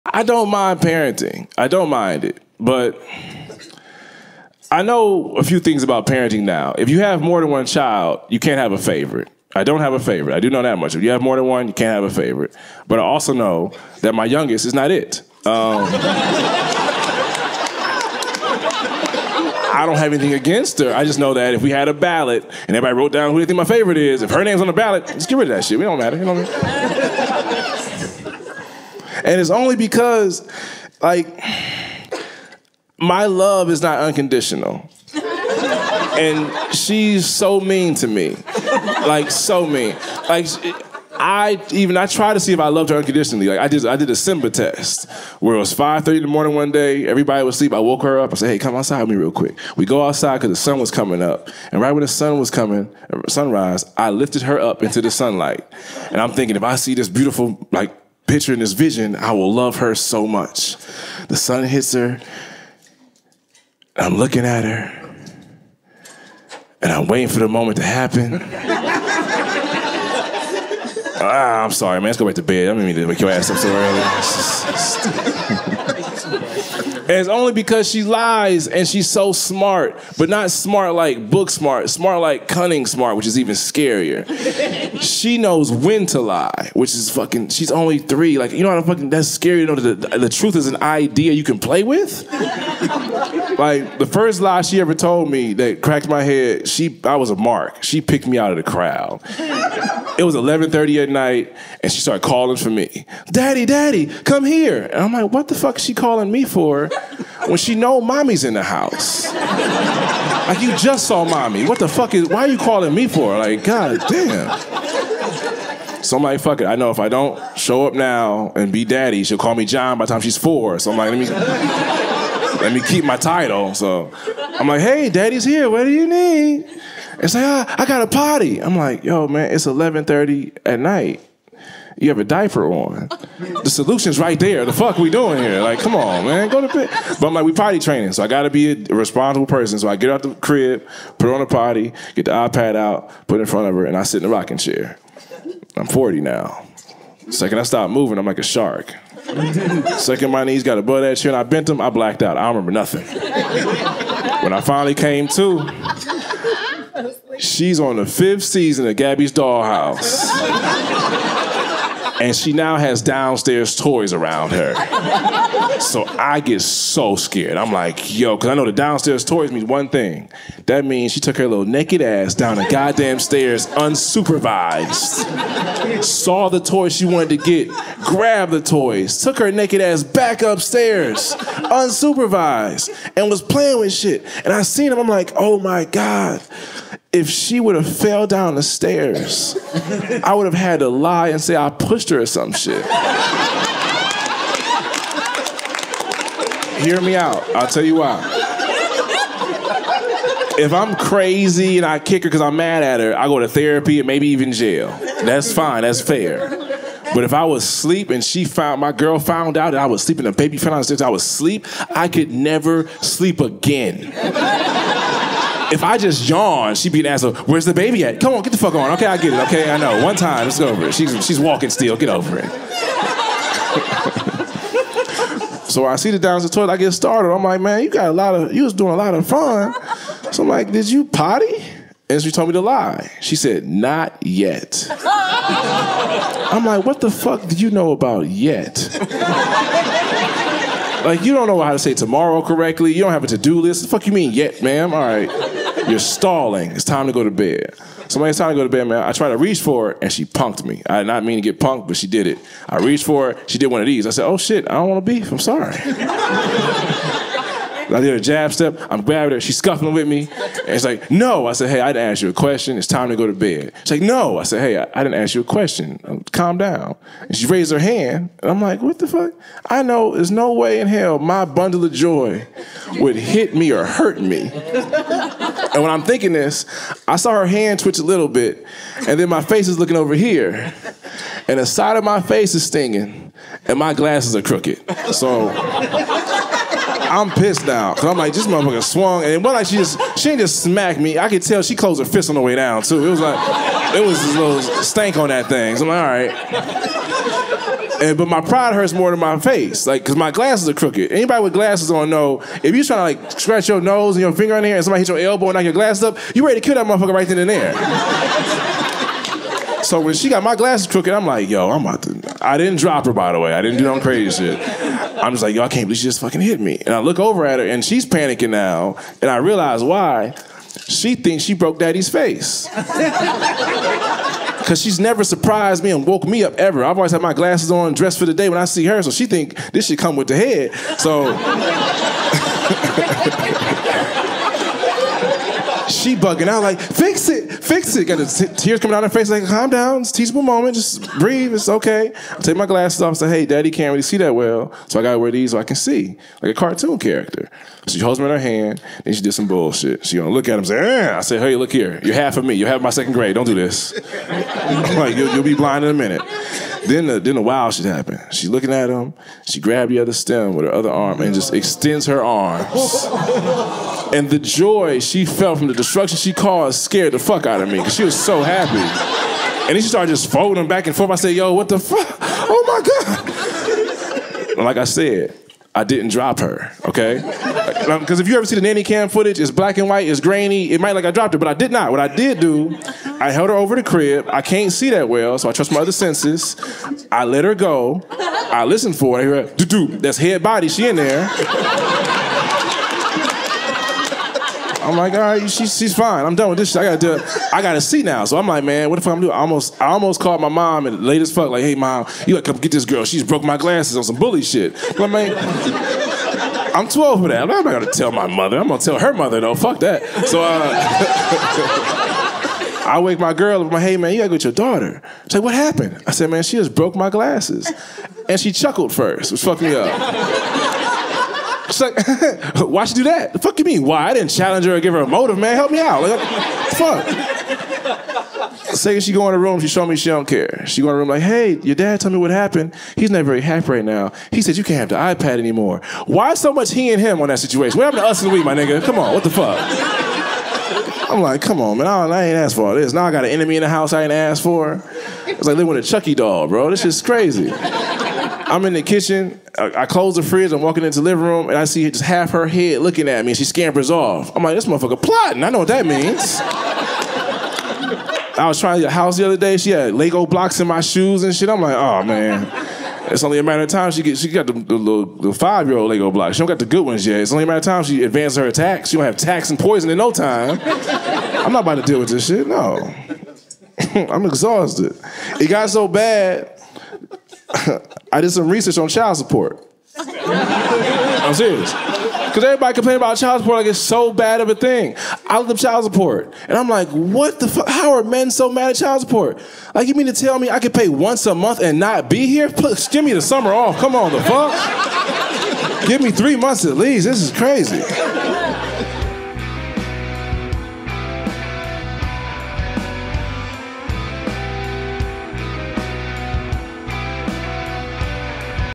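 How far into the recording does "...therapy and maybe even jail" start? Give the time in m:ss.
3:23.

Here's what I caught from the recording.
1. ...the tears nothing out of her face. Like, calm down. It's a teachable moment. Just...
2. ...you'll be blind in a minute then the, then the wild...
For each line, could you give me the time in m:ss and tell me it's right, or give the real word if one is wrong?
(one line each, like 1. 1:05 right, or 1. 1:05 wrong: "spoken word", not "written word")
1. 5:38 wrong: "coming", not "nothing"
2. 5:55 right.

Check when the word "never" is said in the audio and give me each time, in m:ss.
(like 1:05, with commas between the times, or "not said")
3:32, 5:24.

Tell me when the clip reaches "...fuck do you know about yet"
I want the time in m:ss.
3:57.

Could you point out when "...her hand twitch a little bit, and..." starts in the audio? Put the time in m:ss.
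4:37.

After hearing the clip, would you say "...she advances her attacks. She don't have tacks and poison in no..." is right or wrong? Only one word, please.
right.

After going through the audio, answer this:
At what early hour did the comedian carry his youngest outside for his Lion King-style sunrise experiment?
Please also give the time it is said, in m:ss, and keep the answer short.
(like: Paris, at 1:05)
5:30, at 0:45.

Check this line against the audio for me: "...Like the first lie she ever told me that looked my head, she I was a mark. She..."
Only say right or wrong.
wrong.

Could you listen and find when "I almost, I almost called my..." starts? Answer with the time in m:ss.
6:39.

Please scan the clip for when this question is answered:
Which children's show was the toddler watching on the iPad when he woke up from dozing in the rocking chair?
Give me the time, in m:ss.
2:38.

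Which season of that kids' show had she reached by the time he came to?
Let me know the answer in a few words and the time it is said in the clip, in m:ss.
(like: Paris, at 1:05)
5th, at 2:38.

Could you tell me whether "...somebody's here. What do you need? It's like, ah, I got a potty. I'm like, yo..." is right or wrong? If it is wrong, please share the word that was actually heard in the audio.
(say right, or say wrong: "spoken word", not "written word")
wrong: "daddy", not "somebody".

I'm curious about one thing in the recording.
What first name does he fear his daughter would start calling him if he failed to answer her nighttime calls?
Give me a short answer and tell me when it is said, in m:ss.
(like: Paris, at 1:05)
John, at 1:59.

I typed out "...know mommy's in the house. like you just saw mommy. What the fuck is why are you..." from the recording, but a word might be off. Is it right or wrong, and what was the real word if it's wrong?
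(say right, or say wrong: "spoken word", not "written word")
right.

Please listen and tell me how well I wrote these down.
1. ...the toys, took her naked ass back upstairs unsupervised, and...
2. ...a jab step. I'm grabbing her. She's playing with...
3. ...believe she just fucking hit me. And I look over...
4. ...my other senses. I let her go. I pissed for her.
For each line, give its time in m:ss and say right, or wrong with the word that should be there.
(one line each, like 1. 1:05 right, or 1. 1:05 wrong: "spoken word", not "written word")
1. 2:58 right
2. 4:18 wrong: "scuffling", not "playing"
3. 5:15 right
4. 6:25 wrong: "listened", not "pissed".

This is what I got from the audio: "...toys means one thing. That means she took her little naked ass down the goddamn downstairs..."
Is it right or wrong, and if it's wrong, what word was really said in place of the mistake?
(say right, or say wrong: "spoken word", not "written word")
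wrong: "stairs", not "downstairs".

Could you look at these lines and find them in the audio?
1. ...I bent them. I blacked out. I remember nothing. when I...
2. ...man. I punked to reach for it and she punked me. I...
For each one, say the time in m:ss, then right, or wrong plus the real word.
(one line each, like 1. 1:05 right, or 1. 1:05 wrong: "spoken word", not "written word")
1. 2:31 right
2. 4:08 wrong: "tried", not "punked".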